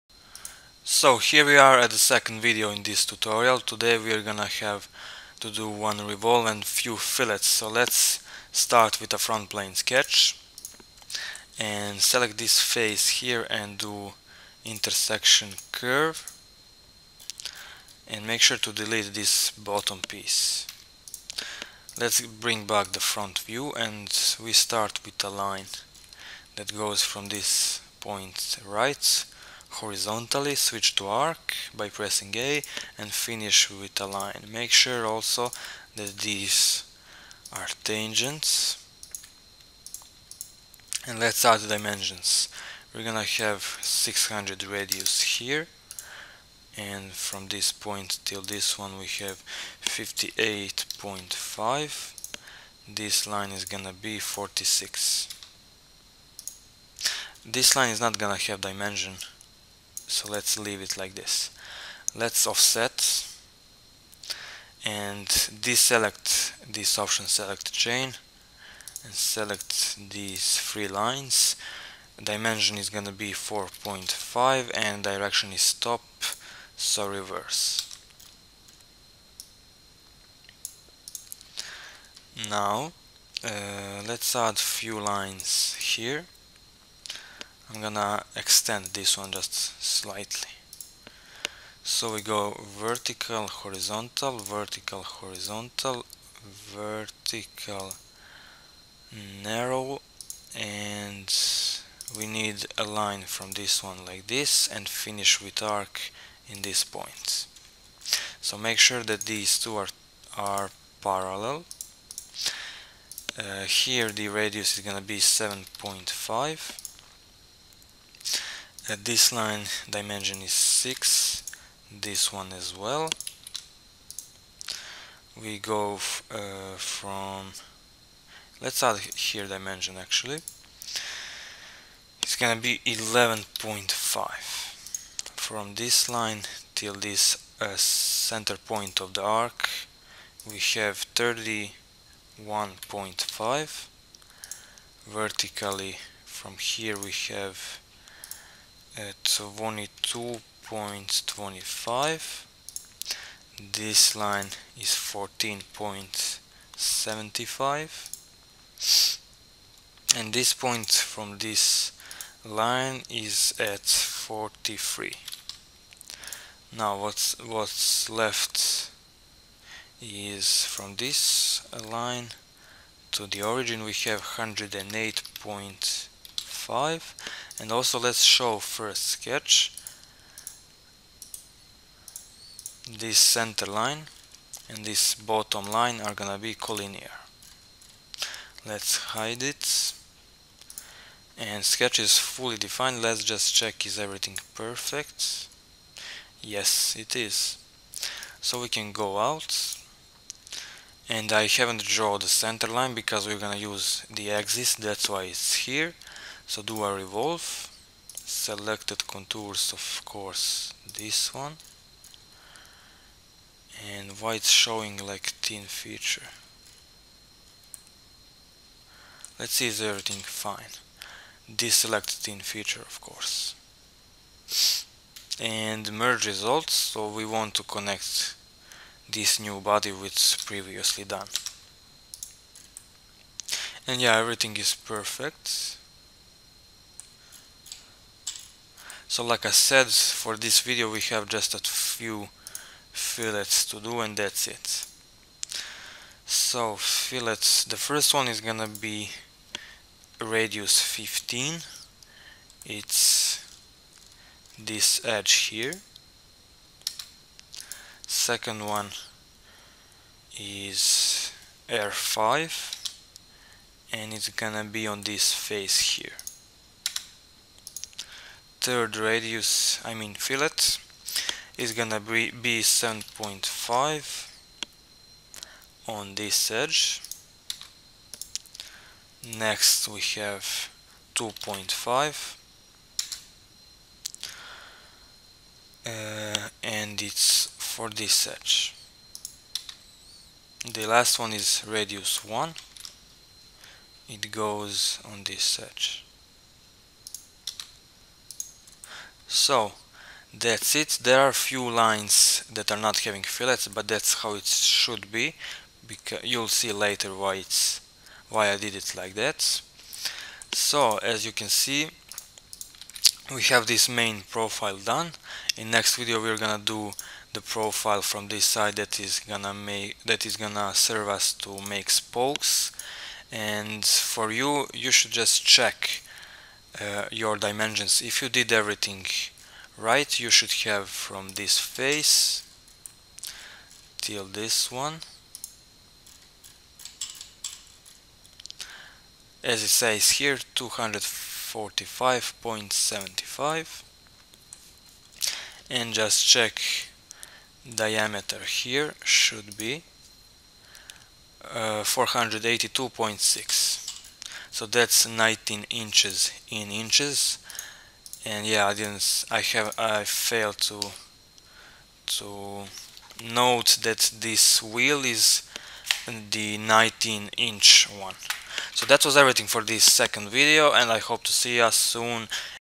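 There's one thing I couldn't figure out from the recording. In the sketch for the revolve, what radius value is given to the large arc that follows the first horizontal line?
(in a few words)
600.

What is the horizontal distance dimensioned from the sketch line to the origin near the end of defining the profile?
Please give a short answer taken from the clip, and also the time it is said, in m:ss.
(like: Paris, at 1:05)
108.5, at 2:54.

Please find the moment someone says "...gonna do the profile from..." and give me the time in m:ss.
5:16.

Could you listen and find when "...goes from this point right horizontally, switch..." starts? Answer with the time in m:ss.
0:26.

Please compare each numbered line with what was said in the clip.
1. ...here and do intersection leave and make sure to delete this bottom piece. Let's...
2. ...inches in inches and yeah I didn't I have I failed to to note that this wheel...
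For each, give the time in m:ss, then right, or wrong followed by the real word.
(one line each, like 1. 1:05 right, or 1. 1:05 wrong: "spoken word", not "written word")
1. 0:13 wrong: "curve", not "leave"
2. 5:55 right.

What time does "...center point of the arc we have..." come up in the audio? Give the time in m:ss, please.
2:17.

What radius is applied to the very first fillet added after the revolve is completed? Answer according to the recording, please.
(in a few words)
15.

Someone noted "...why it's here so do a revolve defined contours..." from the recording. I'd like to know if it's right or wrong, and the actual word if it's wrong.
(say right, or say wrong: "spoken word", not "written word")
wrong: "selected", not "defined".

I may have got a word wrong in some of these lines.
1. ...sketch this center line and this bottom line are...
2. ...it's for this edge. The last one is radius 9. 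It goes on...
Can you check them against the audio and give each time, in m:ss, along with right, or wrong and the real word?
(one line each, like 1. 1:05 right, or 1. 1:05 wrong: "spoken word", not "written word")
1. 2:59 right
2. 4:47 wrong: "1", not "9".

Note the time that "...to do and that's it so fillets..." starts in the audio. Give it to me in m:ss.
4:03.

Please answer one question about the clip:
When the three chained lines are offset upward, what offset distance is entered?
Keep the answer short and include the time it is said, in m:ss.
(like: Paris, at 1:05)
4.5, at 1:13.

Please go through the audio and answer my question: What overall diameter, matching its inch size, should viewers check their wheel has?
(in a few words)
482.6.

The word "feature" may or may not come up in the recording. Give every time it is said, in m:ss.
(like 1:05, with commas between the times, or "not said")
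3:35, 3:42.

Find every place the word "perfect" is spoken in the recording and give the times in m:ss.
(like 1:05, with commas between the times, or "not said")
3:14, 3:54.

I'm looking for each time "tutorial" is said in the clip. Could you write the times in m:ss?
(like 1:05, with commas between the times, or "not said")
0:03.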